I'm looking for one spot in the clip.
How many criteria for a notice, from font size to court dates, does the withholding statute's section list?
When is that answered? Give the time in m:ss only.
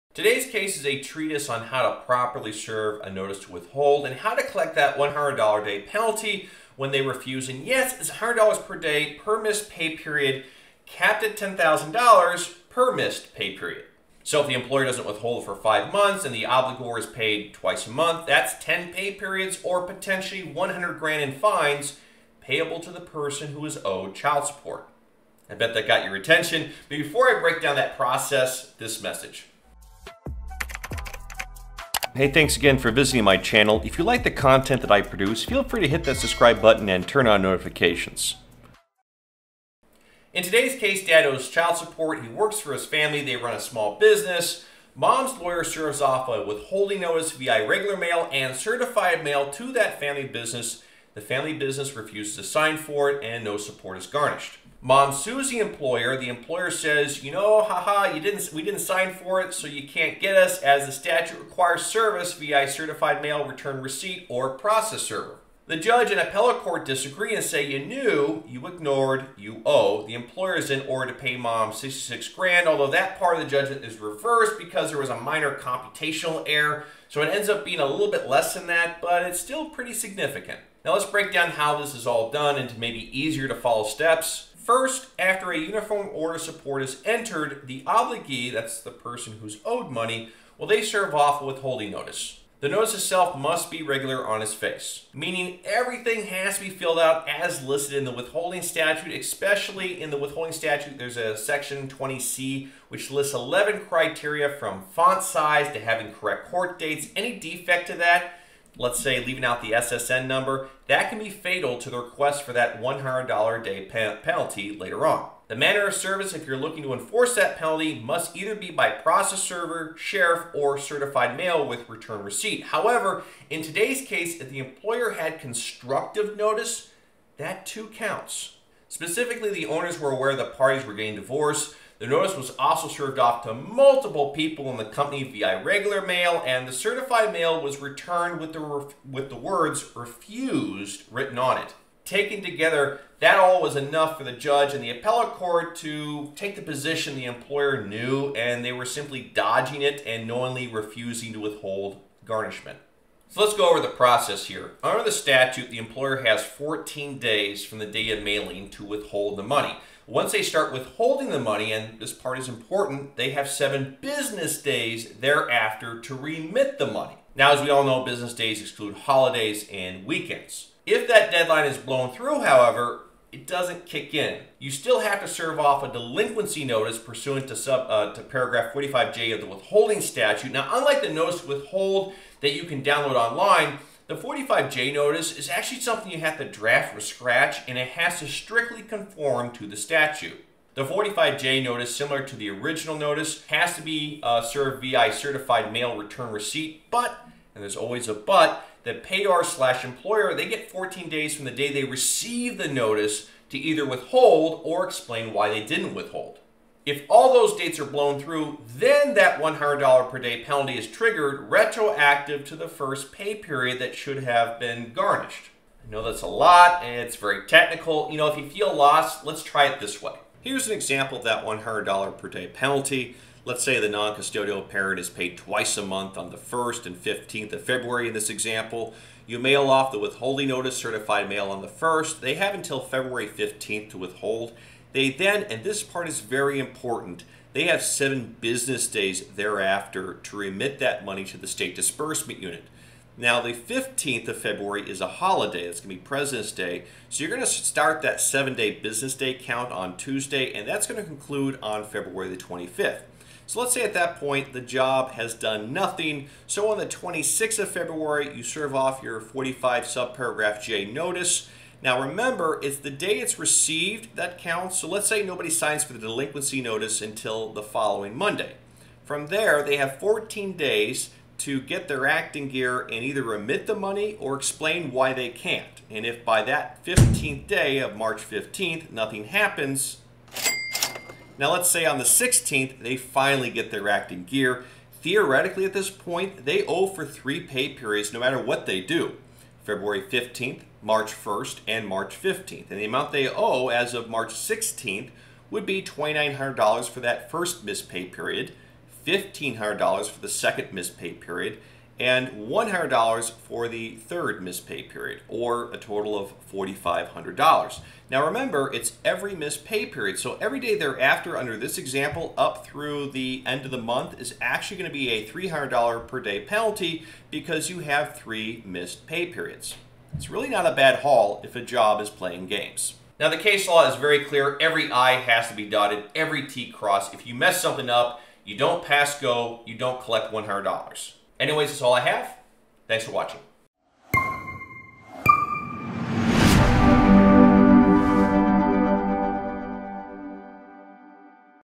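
1:43.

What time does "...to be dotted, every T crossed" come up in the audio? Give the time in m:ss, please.
5:25.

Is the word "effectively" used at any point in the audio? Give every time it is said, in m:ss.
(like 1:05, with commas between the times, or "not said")
not said.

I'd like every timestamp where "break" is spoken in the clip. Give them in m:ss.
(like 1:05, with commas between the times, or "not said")
0:27, 1:21.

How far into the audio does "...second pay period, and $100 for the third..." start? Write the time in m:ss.
5:00.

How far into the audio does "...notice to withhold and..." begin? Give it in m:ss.
0:03.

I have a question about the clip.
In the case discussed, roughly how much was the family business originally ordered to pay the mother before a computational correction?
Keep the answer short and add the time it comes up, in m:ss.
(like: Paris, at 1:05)
66 grand, at 1:11.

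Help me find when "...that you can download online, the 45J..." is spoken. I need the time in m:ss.
3:02.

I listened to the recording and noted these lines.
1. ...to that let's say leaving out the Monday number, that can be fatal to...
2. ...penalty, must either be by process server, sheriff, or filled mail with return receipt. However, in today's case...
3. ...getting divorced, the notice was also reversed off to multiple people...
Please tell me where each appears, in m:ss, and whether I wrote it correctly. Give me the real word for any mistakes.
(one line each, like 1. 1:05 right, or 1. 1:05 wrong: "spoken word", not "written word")
1. 1:47 wrong: "SSN", not "Monday"
2. 1:57 wrong: "certified", not "filled"
3. 2:10 wrong: "served", not "reversed".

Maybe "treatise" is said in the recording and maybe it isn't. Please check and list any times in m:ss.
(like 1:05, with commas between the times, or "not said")
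0:00.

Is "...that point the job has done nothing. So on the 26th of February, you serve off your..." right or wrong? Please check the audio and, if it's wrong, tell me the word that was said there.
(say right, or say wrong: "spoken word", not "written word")
right.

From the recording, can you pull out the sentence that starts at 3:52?
They have until February 15th to withhold.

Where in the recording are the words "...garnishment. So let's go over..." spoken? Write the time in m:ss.
2:32.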